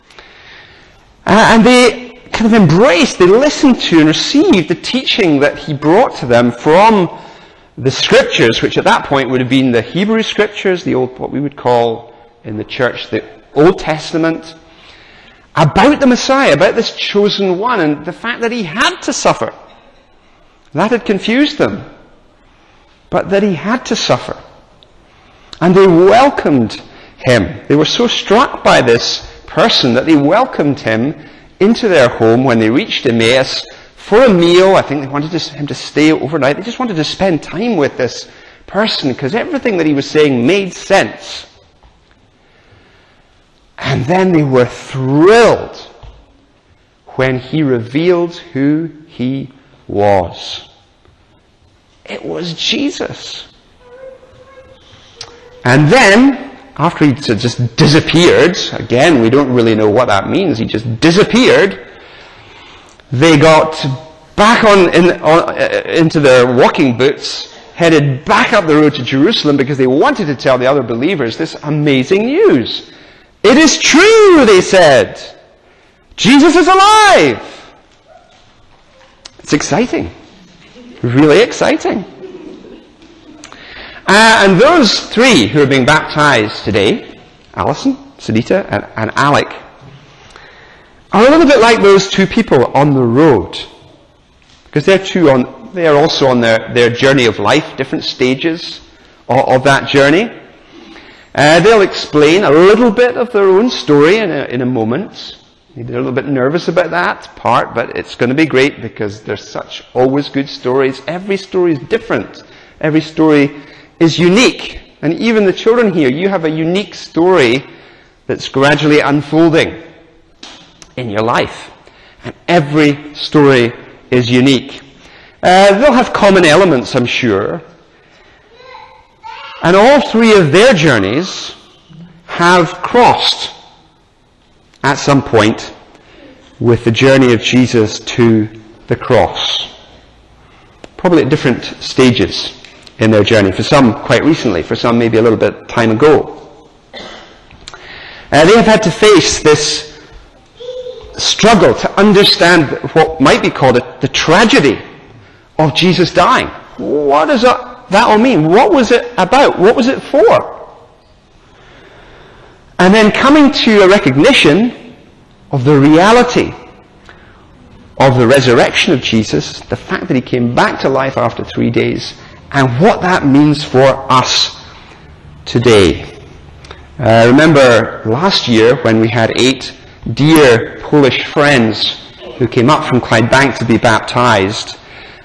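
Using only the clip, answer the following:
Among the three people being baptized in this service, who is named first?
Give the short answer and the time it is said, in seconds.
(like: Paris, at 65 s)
Alison, at 87 s.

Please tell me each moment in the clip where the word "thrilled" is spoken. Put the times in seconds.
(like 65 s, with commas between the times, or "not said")
44 s.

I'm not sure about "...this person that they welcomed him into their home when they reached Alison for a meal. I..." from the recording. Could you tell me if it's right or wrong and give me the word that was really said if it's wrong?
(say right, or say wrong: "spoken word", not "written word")
wrong: "Emmaus", not "Alison".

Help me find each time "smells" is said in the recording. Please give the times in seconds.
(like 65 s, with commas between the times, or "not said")
not said.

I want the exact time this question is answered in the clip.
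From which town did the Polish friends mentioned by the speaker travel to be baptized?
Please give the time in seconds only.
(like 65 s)
182 s.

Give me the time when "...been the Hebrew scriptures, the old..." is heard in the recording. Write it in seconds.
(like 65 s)
9 s.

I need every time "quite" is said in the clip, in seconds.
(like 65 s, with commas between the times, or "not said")
144 s.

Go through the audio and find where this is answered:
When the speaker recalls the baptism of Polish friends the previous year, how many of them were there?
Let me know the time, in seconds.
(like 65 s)
179 s.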